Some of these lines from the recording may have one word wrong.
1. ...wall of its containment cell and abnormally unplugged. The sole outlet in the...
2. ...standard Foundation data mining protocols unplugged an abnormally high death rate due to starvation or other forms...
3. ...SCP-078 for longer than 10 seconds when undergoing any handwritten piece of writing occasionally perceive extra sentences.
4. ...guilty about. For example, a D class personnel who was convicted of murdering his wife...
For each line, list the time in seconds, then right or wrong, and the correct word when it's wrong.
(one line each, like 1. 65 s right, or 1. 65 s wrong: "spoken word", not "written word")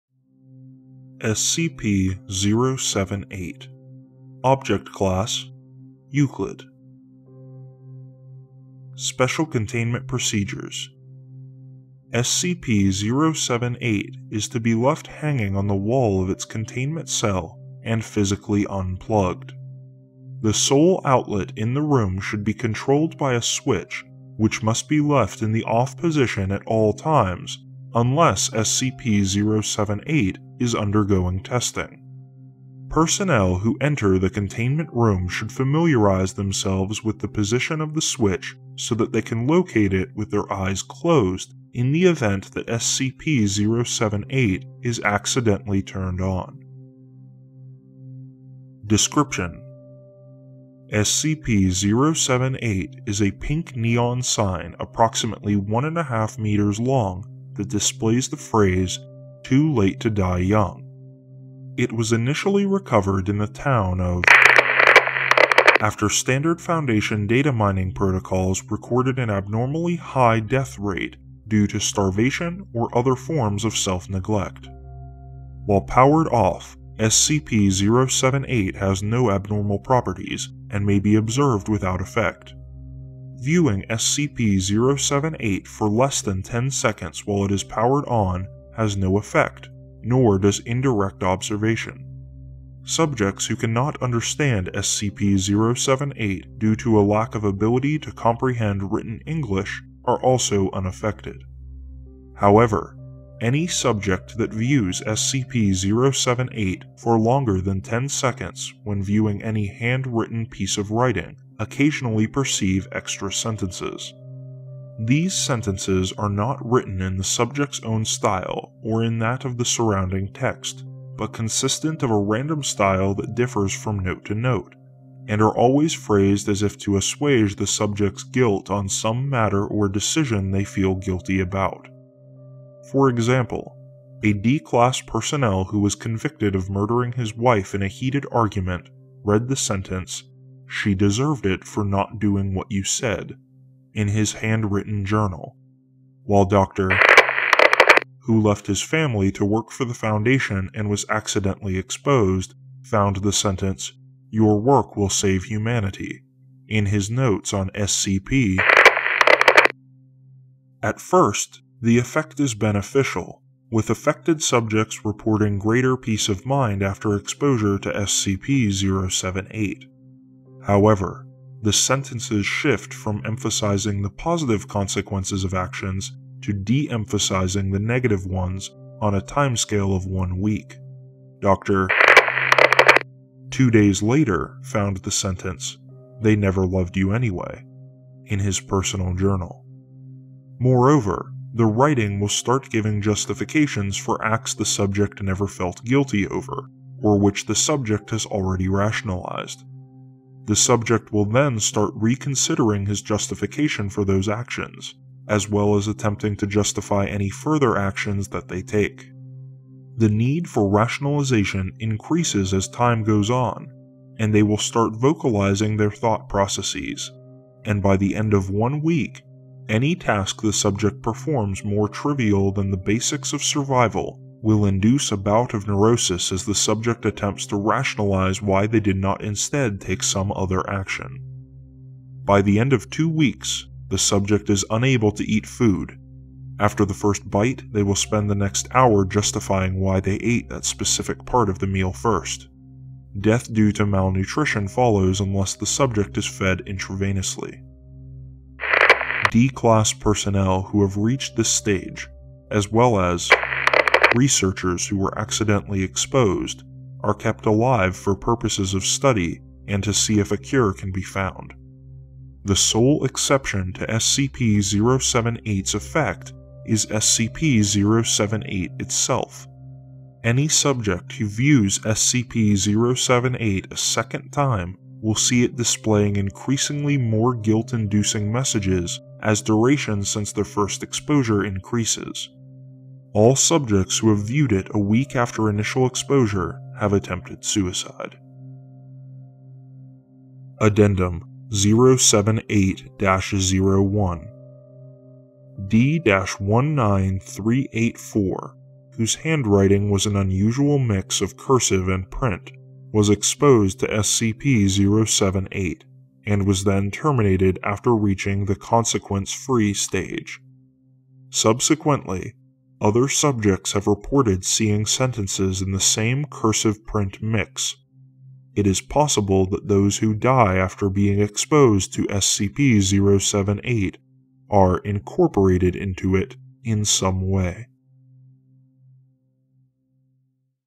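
1. 15 s wrong: "physically", not "abnormally"
2. 66 s wrong: "recorded", not "unplugged"
3. 105 s wrong: "viewing", not "undergoing"
4. 130 s right.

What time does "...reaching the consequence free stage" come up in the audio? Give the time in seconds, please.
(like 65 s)
307 s.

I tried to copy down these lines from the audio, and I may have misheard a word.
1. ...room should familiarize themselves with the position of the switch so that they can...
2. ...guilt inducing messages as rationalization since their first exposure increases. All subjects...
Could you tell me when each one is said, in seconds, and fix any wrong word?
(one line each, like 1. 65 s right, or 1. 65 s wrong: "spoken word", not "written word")
1. 34 s right
2. 277 s wrong: "duration", not "rationalization".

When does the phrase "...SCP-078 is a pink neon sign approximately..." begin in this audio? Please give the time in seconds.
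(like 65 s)
50 s.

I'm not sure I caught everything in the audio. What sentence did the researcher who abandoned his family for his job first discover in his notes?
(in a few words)
Your work will save humanity.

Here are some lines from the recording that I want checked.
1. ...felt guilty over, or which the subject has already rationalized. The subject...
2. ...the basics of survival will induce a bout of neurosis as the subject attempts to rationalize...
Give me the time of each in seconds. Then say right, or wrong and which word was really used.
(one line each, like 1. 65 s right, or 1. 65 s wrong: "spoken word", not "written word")
1. 195 s right
2. 222 s right.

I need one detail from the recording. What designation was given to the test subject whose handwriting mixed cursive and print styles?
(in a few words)
D-19384.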